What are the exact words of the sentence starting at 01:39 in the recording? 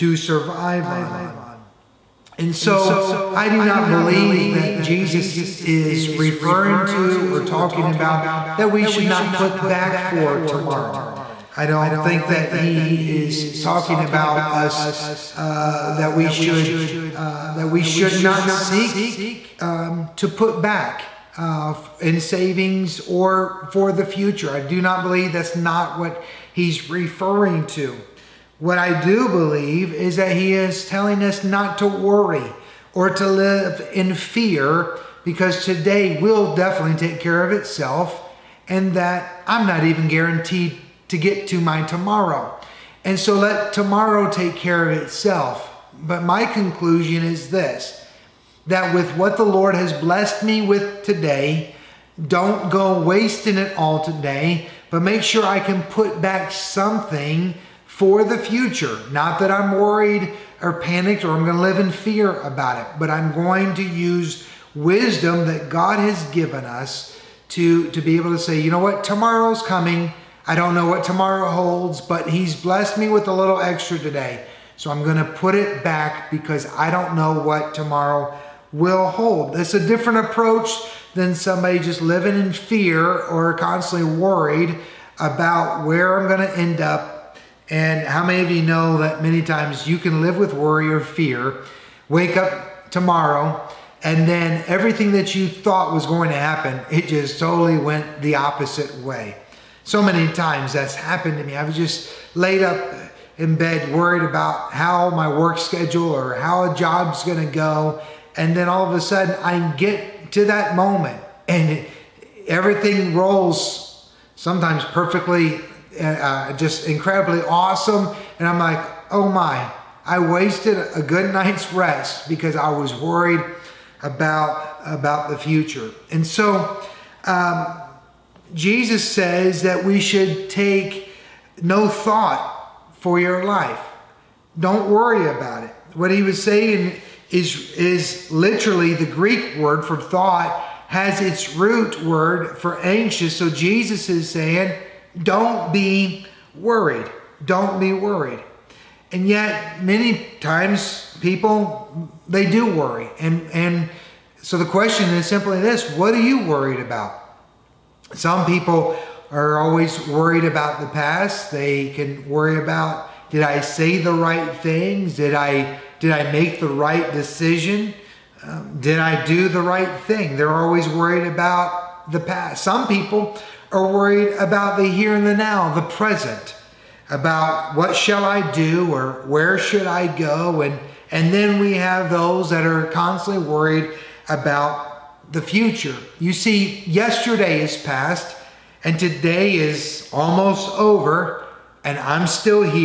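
So many times that's happened to me.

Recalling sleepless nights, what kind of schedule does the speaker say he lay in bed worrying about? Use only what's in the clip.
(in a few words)
work schedule.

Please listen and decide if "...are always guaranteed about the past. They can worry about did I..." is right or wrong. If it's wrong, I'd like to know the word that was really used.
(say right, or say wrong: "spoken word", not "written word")
wrong: "worried", not "guaranteed".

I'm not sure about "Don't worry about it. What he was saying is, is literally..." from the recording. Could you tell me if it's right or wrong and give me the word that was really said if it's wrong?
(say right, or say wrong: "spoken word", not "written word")
right.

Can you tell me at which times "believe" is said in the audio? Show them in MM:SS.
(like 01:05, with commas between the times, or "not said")
00:03, 00:25, 00:29.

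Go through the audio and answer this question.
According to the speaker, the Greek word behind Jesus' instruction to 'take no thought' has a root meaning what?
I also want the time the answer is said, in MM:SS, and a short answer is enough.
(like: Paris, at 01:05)
anxious, at 02:22.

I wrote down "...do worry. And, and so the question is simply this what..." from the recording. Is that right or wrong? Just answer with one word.
right.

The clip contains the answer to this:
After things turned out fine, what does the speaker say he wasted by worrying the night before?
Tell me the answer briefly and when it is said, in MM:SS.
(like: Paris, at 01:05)
a good night's rest, at 02:01.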